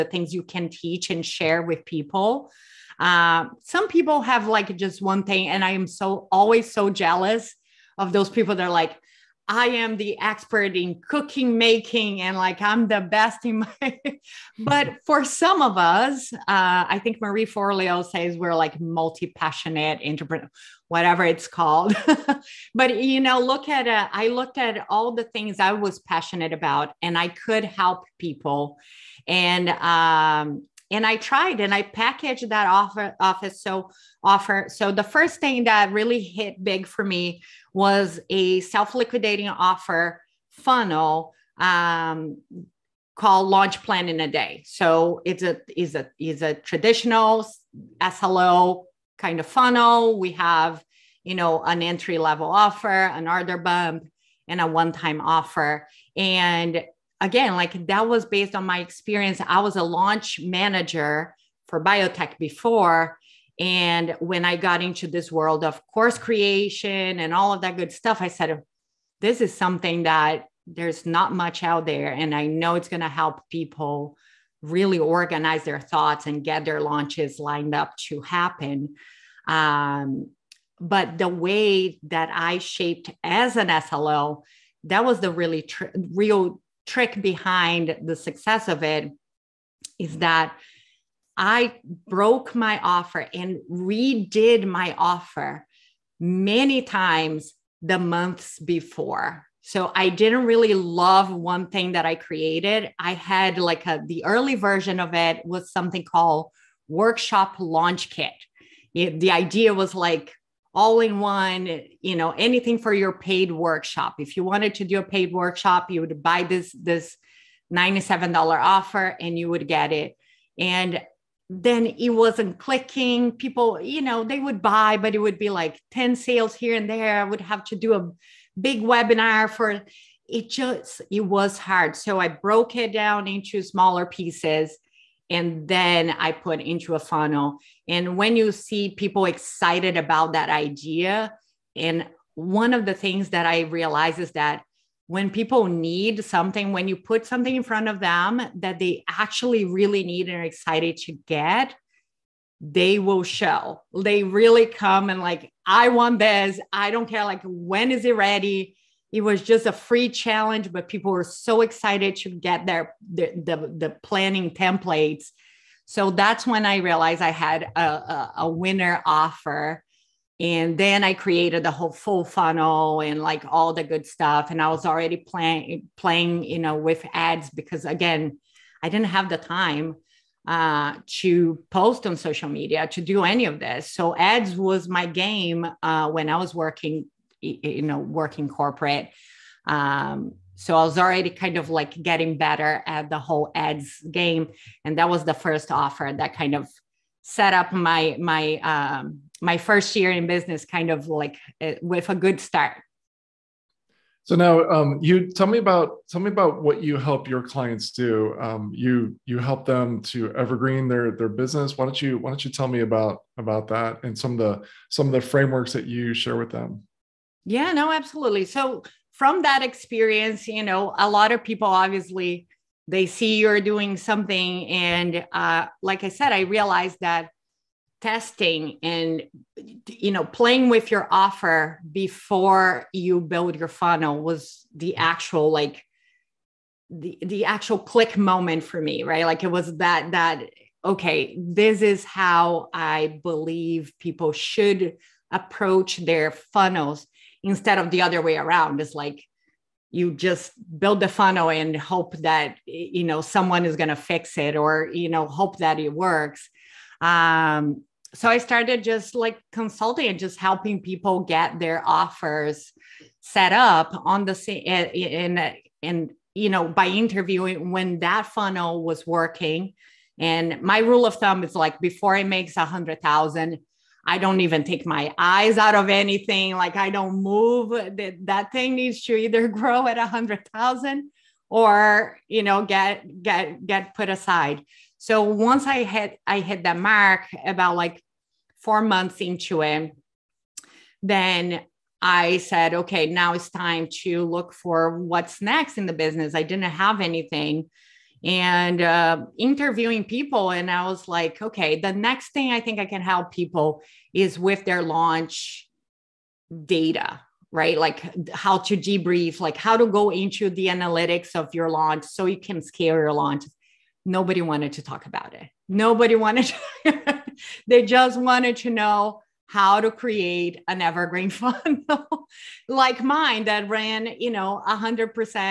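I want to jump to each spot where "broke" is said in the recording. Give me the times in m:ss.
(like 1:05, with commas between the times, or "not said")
1:32, 2:12.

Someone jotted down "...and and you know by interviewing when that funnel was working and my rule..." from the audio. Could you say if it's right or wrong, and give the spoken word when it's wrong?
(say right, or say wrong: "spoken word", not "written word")
right.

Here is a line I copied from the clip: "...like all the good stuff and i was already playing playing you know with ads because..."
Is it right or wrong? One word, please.
right.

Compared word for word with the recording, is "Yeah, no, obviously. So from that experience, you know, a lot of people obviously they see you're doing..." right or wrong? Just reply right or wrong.
wrong.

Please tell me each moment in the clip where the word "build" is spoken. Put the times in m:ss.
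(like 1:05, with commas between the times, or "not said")
3:53, 4:10.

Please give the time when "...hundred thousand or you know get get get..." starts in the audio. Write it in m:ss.
4:40.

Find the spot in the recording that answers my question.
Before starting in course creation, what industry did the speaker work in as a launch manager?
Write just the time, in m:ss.
1:01.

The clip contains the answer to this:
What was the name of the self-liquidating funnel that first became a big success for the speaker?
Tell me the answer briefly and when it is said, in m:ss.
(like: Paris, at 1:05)
Launch Plan in a Day, at 0:43.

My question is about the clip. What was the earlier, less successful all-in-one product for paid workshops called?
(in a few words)
Workshop Launch Kit.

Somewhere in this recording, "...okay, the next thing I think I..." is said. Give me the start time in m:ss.
5:01.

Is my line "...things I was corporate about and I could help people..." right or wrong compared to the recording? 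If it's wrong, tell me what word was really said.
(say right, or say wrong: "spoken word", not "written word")
wrong: "passionate", not "corporate".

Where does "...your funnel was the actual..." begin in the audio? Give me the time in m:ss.
3:53.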